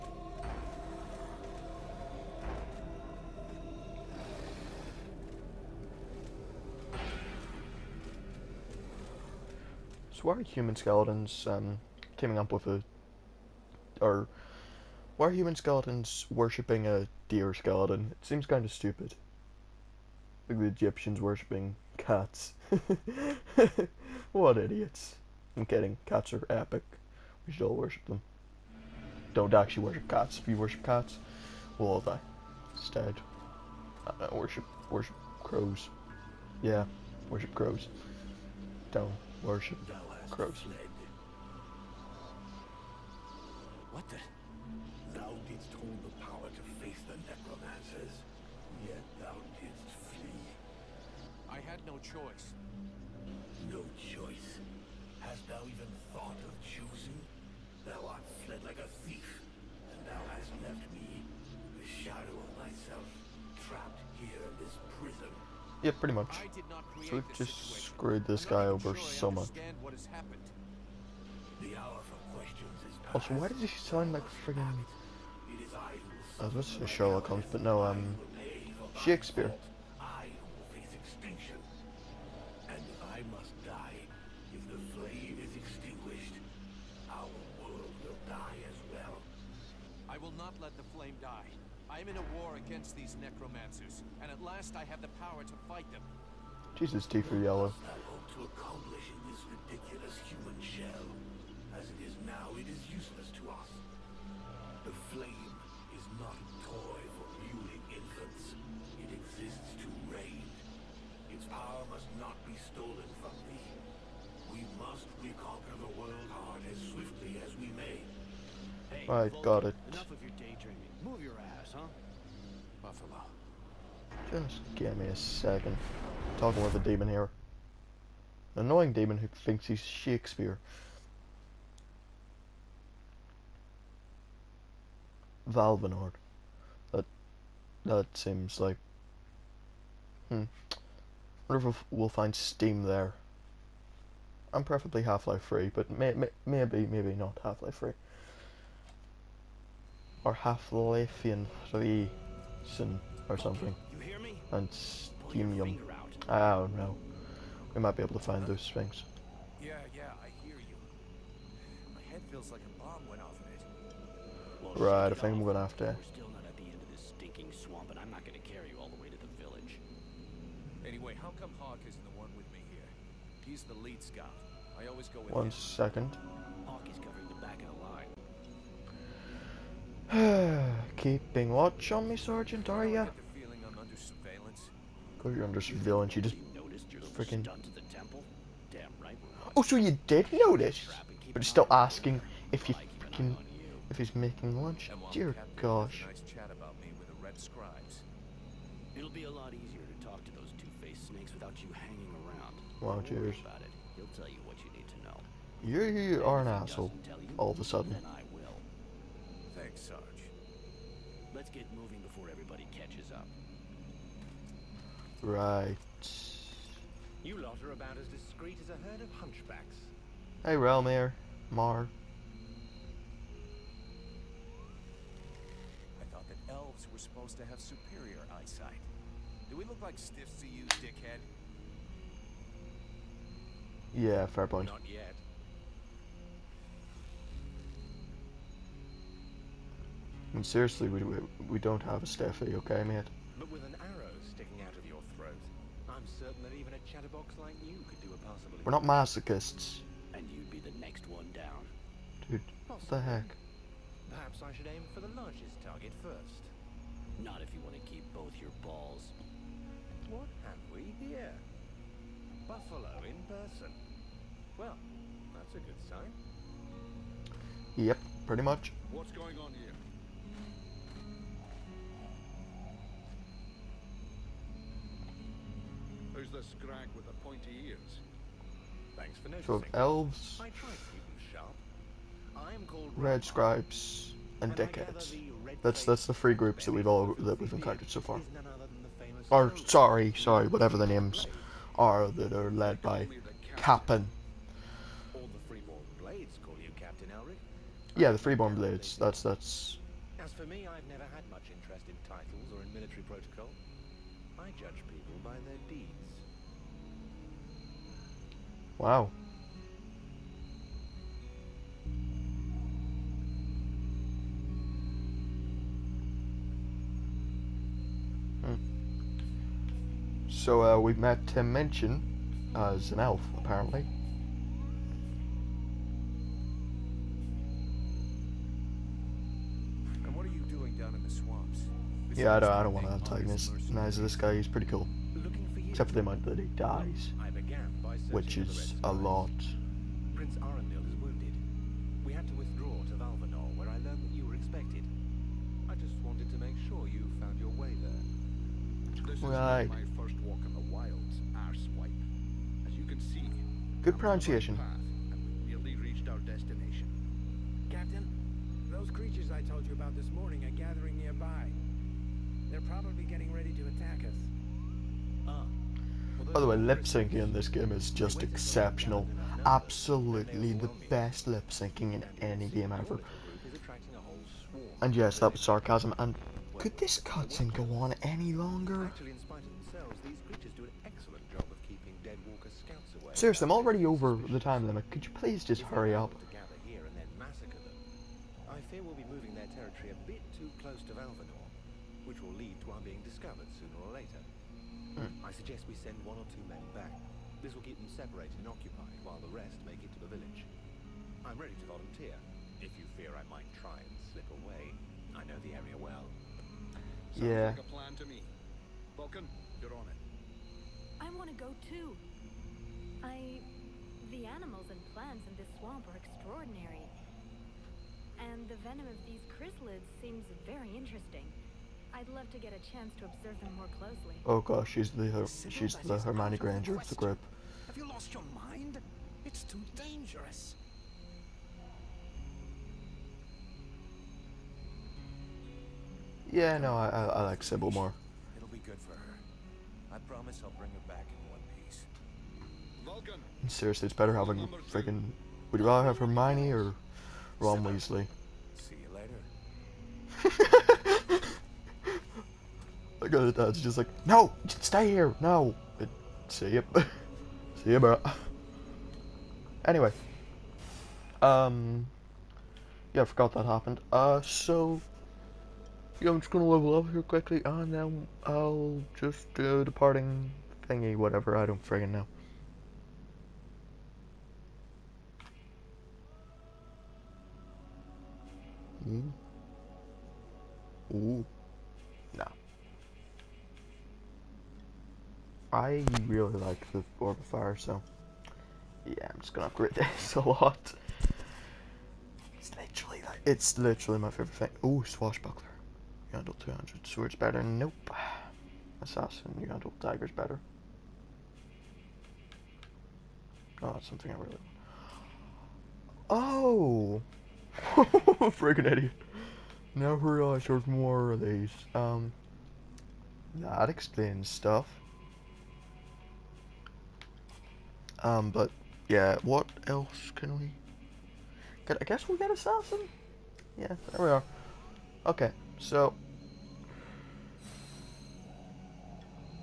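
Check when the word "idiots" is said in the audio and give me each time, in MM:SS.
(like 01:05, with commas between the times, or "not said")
00:24, 08:28.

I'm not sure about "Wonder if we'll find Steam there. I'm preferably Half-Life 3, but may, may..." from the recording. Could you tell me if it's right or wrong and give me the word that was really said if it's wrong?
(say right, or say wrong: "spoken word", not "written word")
right.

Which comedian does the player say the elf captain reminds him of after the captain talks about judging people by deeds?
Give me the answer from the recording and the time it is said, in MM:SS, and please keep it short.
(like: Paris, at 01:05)
Tim Minchin, at 05:21.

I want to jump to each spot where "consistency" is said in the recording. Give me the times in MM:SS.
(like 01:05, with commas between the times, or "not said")
not said.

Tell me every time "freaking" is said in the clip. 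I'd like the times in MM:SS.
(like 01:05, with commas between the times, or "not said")
03:07, 03:12, 07:24.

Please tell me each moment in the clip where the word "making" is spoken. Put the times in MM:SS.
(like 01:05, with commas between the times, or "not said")
03:14.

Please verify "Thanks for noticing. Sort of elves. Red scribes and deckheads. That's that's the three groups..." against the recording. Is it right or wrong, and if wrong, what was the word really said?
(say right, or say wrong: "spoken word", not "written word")
right.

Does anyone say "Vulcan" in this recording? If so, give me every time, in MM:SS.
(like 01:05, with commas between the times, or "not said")
06:48, 07:22.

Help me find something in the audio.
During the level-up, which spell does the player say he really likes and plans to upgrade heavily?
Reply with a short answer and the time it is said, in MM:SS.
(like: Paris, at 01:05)
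Orb of Fire, at 08:06.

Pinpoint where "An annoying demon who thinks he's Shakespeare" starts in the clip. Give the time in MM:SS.
02:08.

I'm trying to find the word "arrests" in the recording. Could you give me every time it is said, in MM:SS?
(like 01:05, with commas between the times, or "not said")
not said.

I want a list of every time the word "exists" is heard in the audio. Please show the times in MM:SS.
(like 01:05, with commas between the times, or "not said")
01:49.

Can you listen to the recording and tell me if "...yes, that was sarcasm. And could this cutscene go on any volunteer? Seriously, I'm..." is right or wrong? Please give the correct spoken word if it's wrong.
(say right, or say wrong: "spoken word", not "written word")
wrong: "longer", not "volunteer".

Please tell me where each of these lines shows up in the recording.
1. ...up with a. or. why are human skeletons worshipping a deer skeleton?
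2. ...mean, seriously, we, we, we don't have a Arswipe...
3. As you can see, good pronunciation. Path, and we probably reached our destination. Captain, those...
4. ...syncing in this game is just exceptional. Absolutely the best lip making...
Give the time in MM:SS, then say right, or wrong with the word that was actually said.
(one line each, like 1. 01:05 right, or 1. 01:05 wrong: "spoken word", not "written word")
1. 00:12 right
2. 04:00 wrong: "Steffi", not "Arswipe"
3. 05:52 wrong: "nearly", not "probably"
4. 06:06 wrong: "syncing", not "making".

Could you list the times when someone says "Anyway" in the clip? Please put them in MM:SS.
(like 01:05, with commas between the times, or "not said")
02:50, 07:39.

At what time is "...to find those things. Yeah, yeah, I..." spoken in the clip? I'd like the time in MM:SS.
02:38.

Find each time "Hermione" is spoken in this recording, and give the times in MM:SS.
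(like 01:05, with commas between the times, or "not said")
07:05, 07:25.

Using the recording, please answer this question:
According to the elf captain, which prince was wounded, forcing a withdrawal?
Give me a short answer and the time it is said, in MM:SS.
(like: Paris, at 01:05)
Prince Arundel, at 05:40.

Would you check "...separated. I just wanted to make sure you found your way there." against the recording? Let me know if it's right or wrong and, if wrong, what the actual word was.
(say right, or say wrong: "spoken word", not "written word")
wrong: "expected", not "separated".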